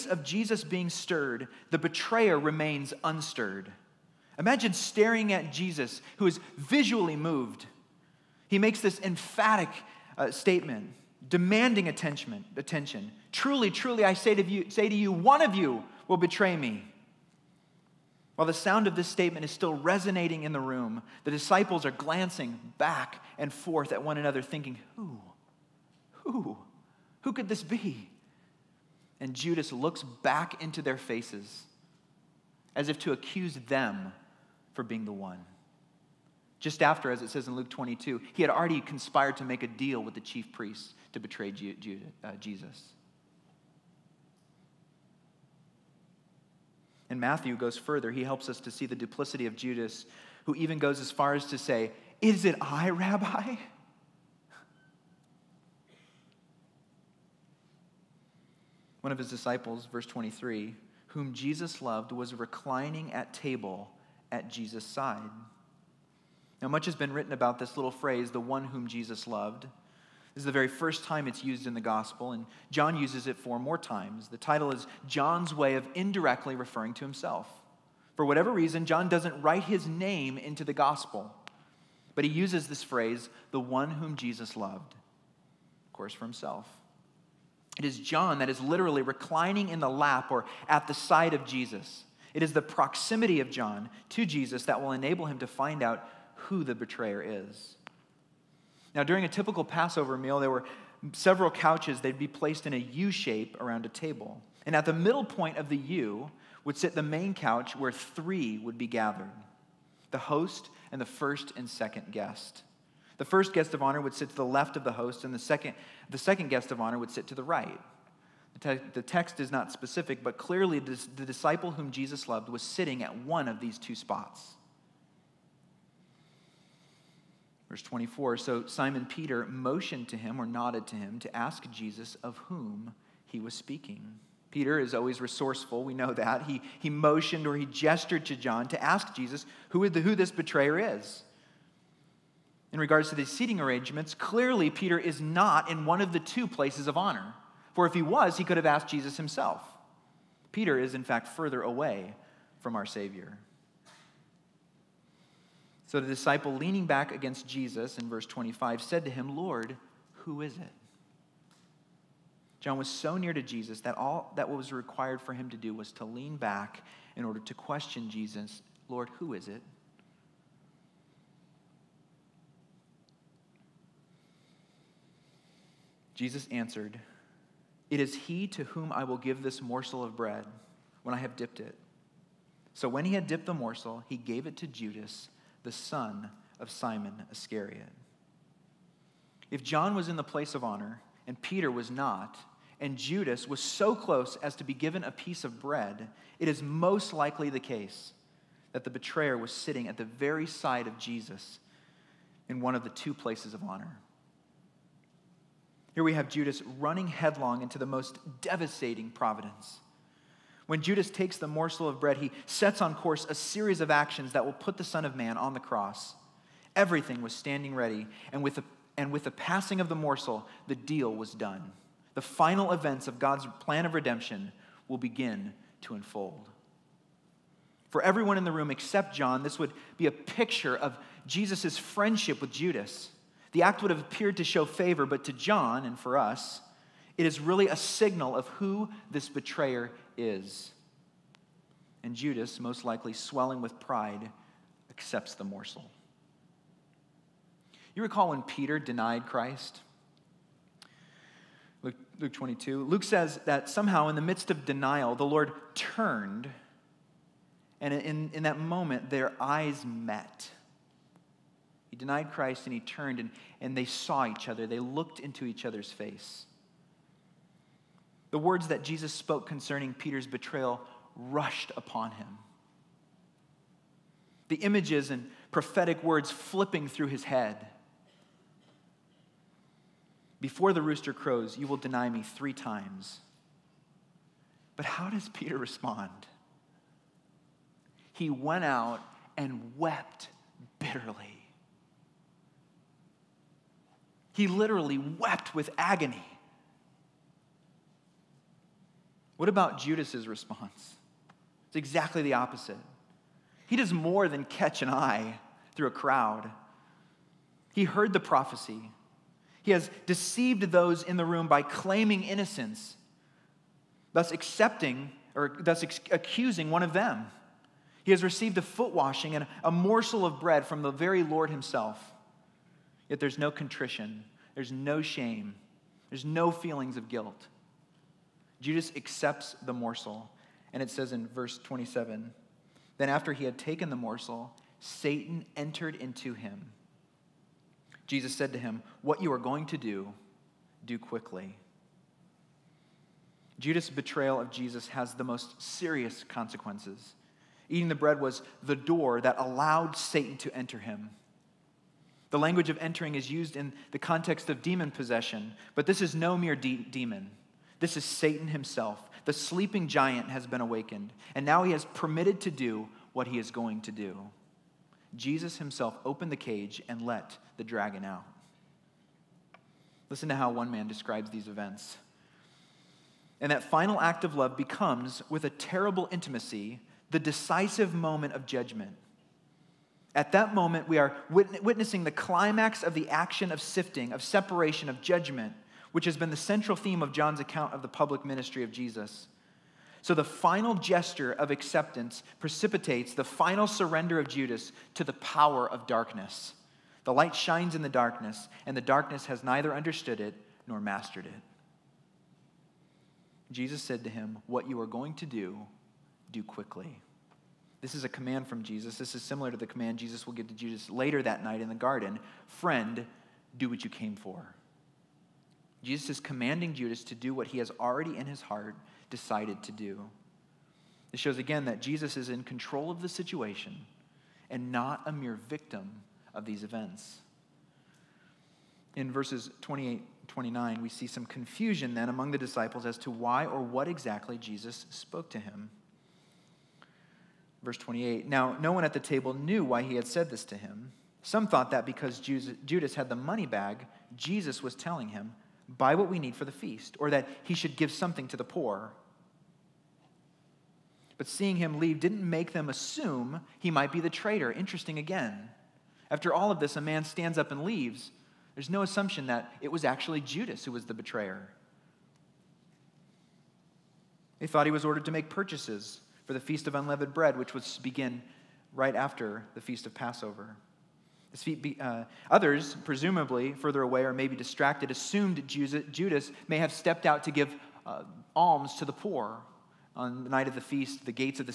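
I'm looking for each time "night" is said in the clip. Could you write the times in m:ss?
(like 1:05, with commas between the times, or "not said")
6:51, 8:00.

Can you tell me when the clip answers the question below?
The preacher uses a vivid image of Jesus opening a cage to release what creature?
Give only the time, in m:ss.
6:07.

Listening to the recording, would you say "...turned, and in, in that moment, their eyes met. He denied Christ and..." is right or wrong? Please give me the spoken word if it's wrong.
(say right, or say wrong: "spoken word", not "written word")
right.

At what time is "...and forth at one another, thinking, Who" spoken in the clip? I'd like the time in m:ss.
0:23.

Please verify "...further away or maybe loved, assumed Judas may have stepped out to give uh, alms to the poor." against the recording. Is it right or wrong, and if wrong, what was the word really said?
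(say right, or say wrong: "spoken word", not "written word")
wrong: "distracted", not "loved".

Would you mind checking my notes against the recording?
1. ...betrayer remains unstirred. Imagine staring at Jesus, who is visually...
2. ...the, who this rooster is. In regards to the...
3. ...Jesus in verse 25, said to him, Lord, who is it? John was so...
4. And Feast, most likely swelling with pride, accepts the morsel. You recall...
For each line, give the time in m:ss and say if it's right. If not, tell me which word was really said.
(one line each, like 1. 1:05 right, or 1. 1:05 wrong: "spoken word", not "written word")
1. 0:01 right
2. 2:19 wrong: "betrayer", not "rooster"
3. 2:37 right
4. 4:02 wrong: "Judas", not "Feast".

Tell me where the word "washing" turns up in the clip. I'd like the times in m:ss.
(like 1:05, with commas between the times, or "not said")
5:18.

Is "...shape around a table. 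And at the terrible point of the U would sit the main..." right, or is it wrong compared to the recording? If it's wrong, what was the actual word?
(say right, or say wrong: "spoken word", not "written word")
wrong: "middle", not "terrible".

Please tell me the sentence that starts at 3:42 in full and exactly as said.
The final events of God's plan of redemption will begin to unfold.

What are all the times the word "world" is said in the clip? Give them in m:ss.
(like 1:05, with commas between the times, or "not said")
not said.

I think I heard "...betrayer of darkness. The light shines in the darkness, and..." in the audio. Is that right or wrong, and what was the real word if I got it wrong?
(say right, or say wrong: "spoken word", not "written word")
wrong: "power", not "betrayer".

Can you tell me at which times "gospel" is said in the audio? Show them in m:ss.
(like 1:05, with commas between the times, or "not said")
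1:11, 1:20.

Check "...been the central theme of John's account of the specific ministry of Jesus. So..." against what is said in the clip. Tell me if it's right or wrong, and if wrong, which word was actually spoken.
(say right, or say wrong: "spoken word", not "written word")
wrong: "public", not "specific".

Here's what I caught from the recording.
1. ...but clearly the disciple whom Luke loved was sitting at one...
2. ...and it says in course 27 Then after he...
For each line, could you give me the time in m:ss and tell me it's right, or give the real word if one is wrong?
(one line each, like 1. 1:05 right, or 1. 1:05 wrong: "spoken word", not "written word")
1. 2:00 wrong: "Jesus", not "Luke"
2. 5:30 wrong: "verse", not "course".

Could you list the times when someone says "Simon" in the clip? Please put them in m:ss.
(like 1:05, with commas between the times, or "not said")
2:08, 3:06.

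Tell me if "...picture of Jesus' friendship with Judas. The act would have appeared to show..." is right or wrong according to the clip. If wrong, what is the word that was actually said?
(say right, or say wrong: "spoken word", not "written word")
right.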